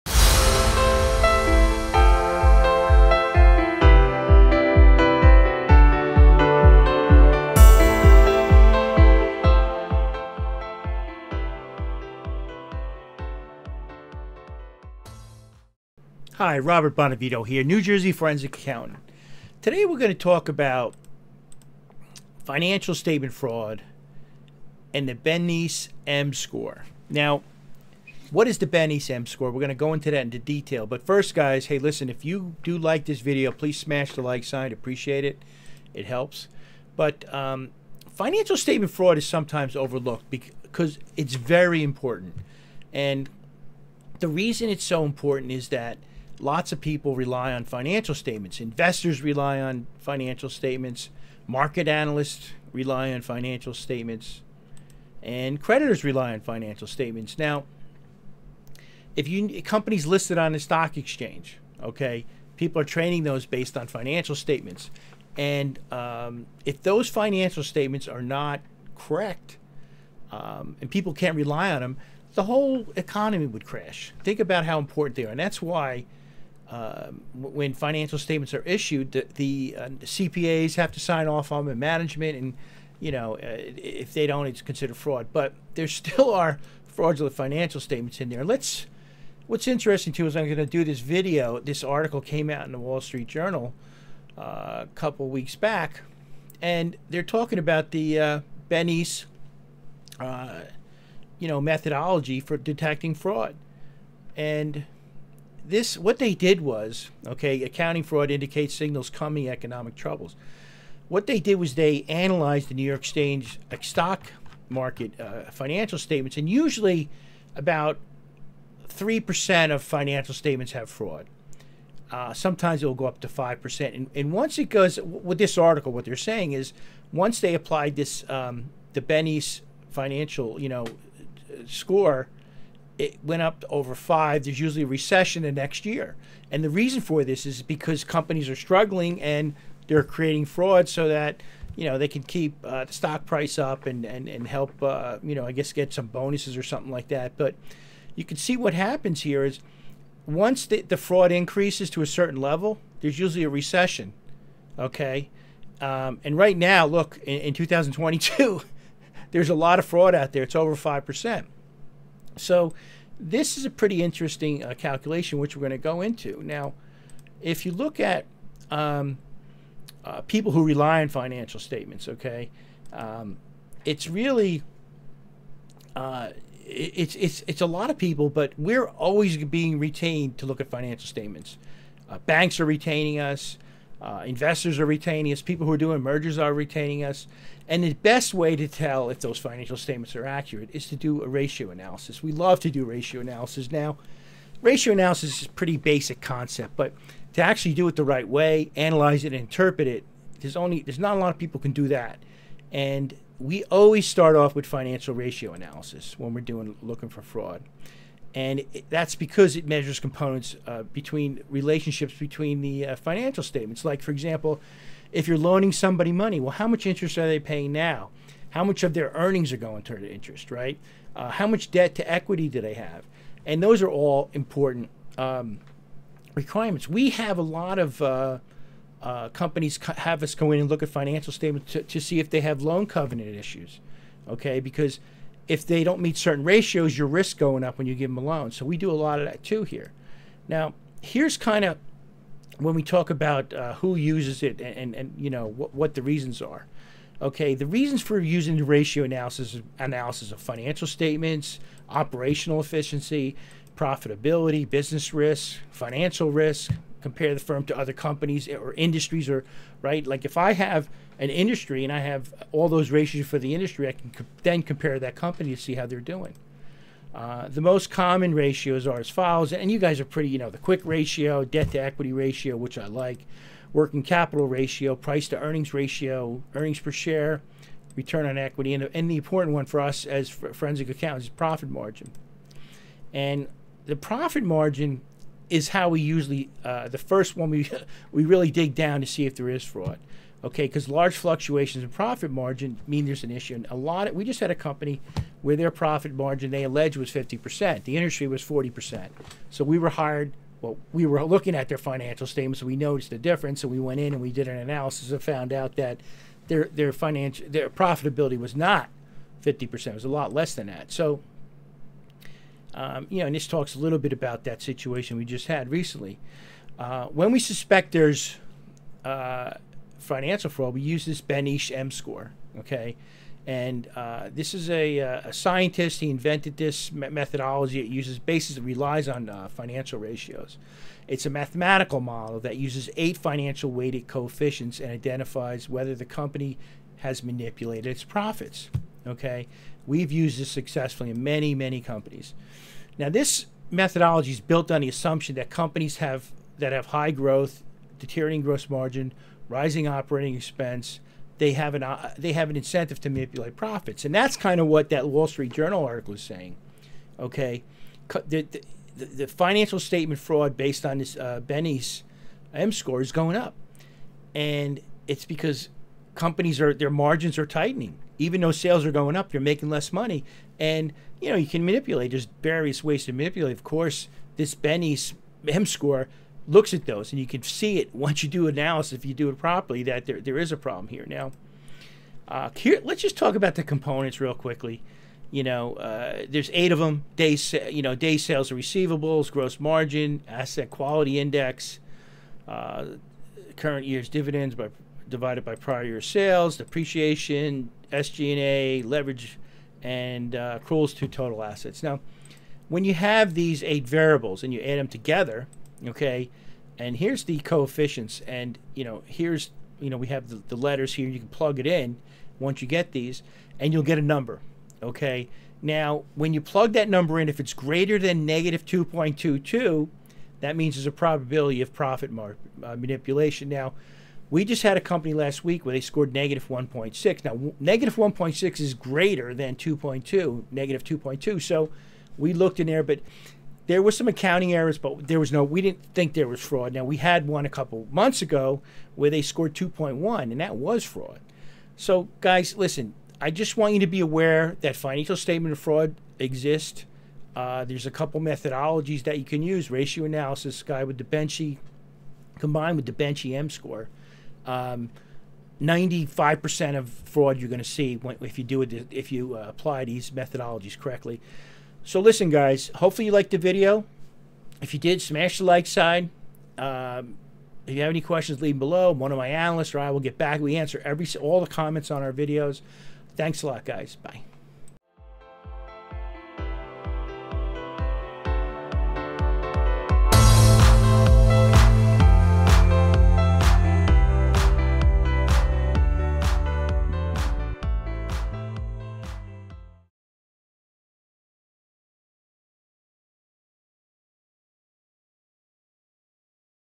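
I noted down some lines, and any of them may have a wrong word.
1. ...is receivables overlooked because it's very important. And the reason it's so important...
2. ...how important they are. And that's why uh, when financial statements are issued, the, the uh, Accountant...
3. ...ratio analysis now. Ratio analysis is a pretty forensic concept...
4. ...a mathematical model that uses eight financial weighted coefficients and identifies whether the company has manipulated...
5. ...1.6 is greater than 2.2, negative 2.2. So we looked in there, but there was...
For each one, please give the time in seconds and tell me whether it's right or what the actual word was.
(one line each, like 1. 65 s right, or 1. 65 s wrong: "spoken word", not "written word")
1. 39 s wrong: "sometimes", not "receivables"
2. 74 s wrong: "CPAs", not "Accountant"
3. 192 s wrong: "basic", not "forensic"
4. 331 s right
5. 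427 s right.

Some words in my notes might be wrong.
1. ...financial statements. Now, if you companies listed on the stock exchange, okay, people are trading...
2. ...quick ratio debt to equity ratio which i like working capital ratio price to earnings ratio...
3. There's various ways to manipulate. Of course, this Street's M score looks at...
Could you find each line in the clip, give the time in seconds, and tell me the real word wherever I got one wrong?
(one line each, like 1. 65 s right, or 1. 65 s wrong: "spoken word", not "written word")
1. 56 s right
2. 270 s right
3. 372 s wrong: "Benny", not "Street".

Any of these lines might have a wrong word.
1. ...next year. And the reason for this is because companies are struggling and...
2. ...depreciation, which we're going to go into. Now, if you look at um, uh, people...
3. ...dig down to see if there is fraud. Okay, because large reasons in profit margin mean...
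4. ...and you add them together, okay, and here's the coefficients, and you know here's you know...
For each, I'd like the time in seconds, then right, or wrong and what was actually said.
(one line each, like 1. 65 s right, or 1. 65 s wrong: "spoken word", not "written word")
1. 135 s right
2. 164 s wrong: "calculation", not "depreciation"
3. 288 s wrong: "fluctuations", not "reasons"
4. 404 s right.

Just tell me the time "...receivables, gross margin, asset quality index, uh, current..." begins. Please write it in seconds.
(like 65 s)
388 s.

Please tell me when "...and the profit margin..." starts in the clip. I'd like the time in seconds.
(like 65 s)
283 s.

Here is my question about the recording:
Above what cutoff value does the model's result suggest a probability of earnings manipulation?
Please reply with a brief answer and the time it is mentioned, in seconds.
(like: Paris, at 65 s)
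-2.22, at 418 s.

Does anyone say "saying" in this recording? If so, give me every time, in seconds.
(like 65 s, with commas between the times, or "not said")
126 s, 356 s.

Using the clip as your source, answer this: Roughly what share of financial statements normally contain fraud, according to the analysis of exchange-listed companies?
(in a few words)
3%.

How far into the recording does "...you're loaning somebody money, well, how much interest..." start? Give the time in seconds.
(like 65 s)
215 s.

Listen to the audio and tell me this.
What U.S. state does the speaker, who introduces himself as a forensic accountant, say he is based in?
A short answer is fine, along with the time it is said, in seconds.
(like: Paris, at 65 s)
New Jersey, at 17 s.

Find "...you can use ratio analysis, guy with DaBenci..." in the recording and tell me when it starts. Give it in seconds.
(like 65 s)
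449 s.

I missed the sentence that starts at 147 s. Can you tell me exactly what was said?
But you can see what happens here is once the, the fraud increases to a certain level, there's usually a recession.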